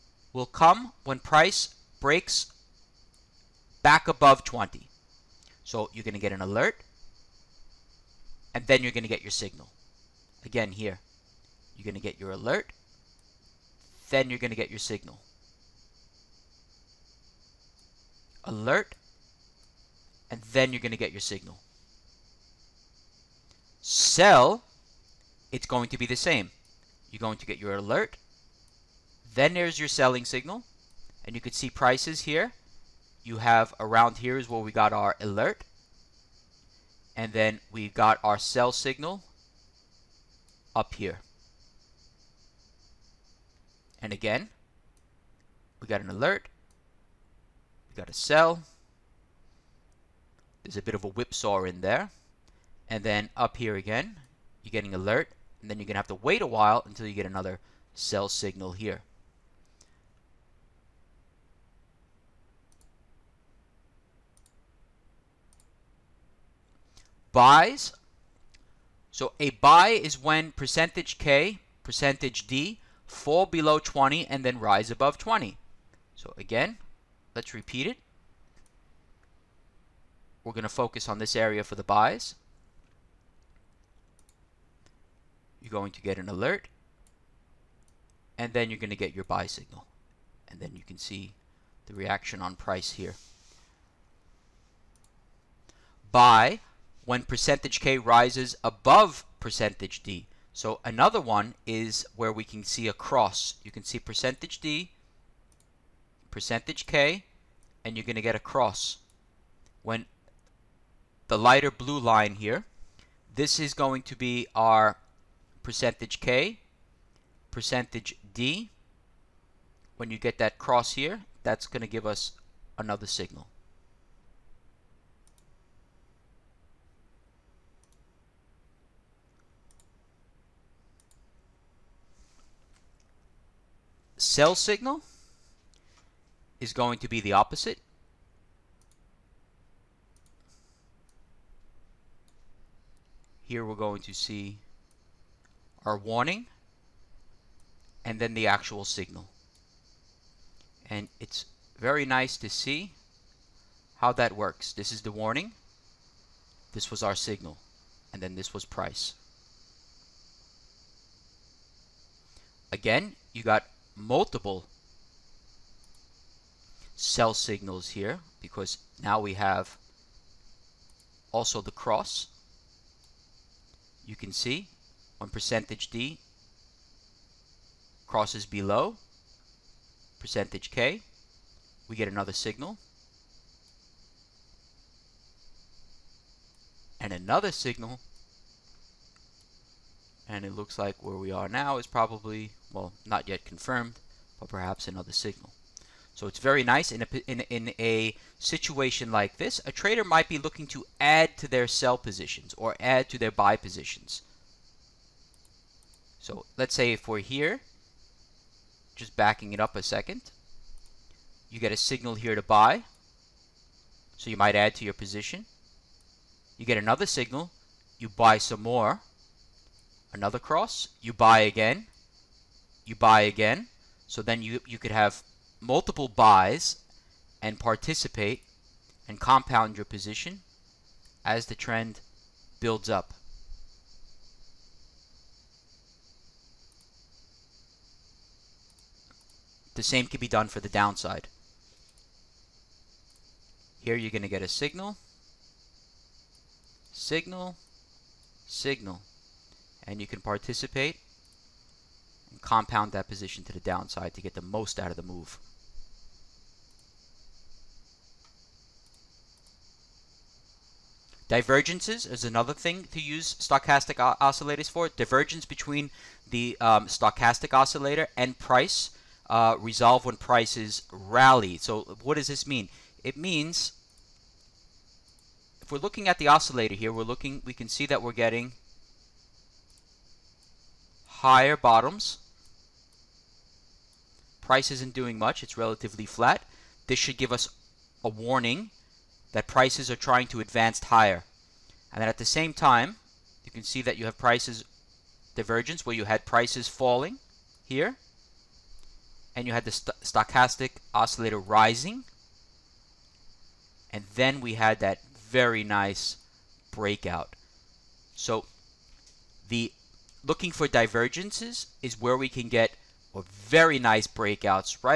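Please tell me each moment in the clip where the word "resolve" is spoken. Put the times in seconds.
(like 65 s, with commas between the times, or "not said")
269 s.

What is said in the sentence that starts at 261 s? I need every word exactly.
Divergences is another thing to use stochastic oscillators for.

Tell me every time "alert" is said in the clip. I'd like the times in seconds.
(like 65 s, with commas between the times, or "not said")
6 s, 12 s, 18 s, 27 s, 35 s, 46 s, 54 s, 86 s.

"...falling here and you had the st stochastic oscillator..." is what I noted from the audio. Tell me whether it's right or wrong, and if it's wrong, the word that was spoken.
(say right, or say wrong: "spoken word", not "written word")
right.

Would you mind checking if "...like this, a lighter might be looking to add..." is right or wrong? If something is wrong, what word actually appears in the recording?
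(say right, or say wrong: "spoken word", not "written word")
wrong: "trader", not "lighter".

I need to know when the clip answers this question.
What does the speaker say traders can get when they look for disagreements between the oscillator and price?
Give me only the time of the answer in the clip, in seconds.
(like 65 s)
313 s.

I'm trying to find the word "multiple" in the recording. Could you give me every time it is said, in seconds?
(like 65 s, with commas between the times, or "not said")
163 s, 225 s.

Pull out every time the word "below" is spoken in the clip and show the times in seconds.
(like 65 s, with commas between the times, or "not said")
73 s, 178 s.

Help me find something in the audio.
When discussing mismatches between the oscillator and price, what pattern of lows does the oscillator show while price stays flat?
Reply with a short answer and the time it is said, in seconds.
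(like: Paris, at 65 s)
Higher bottoms, at 281 s.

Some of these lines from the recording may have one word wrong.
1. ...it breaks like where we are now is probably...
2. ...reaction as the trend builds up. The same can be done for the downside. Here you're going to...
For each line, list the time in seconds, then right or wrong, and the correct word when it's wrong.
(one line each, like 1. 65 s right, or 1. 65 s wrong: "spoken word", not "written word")
1. 190 s wrong: "looks", not "breaks"
2. 229 s wrong: "position", not "reaction".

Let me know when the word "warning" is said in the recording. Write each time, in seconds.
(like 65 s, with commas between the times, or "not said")
145 s, 155 s, 288 s.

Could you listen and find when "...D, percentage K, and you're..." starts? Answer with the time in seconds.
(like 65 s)
104 s.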